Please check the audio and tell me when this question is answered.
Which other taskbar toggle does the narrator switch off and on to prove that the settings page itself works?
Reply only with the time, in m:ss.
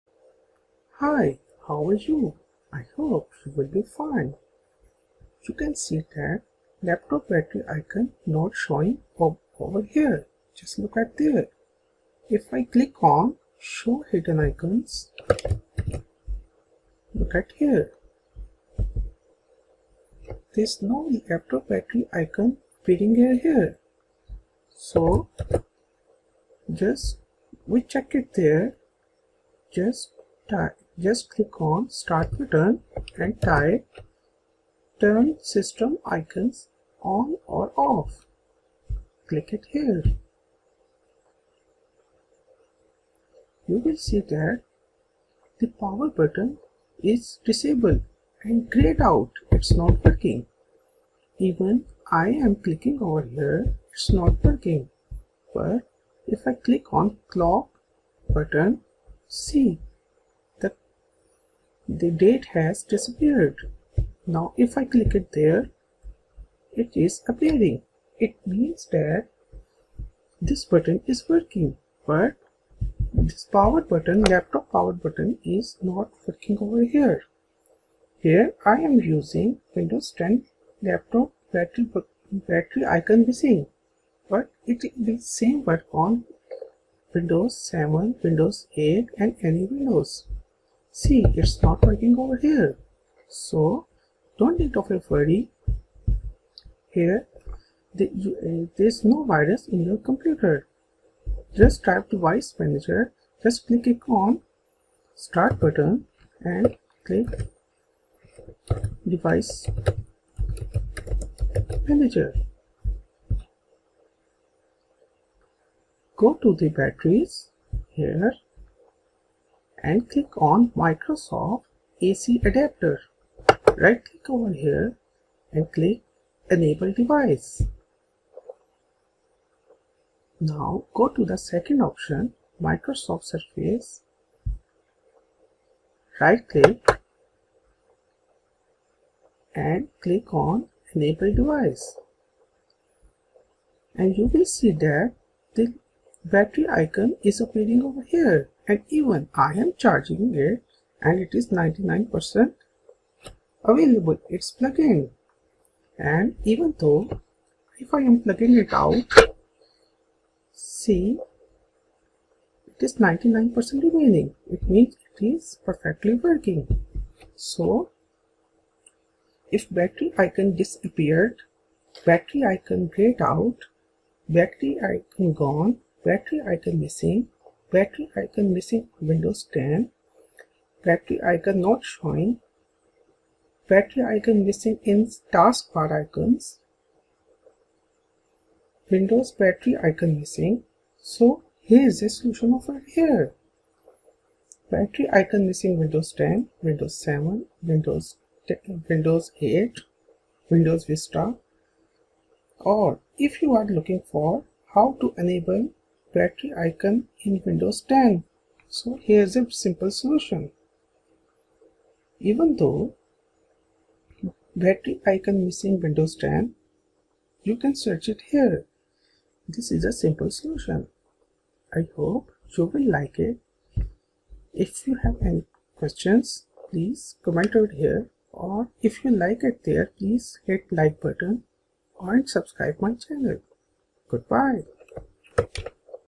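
0:57.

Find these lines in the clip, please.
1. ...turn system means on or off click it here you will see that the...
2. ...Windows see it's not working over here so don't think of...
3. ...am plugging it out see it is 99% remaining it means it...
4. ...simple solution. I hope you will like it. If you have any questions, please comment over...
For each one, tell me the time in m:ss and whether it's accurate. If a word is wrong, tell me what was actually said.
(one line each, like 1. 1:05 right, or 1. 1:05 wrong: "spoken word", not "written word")
1. 0:34 wrong: "icons", not "means"
2. 1:29 right
3. 2:38 right
4. 3:39 right.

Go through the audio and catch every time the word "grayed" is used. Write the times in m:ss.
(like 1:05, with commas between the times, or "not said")
0:48, 2:52.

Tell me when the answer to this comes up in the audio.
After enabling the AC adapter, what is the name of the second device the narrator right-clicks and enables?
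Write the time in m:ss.
2:12.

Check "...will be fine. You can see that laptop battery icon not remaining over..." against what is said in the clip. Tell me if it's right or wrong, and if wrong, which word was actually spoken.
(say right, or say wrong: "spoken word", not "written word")
wrong: "showing", not "remaining".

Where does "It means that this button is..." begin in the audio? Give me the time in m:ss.
1:08.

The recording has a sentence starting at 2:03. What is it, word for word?
Right click over here and click enable device.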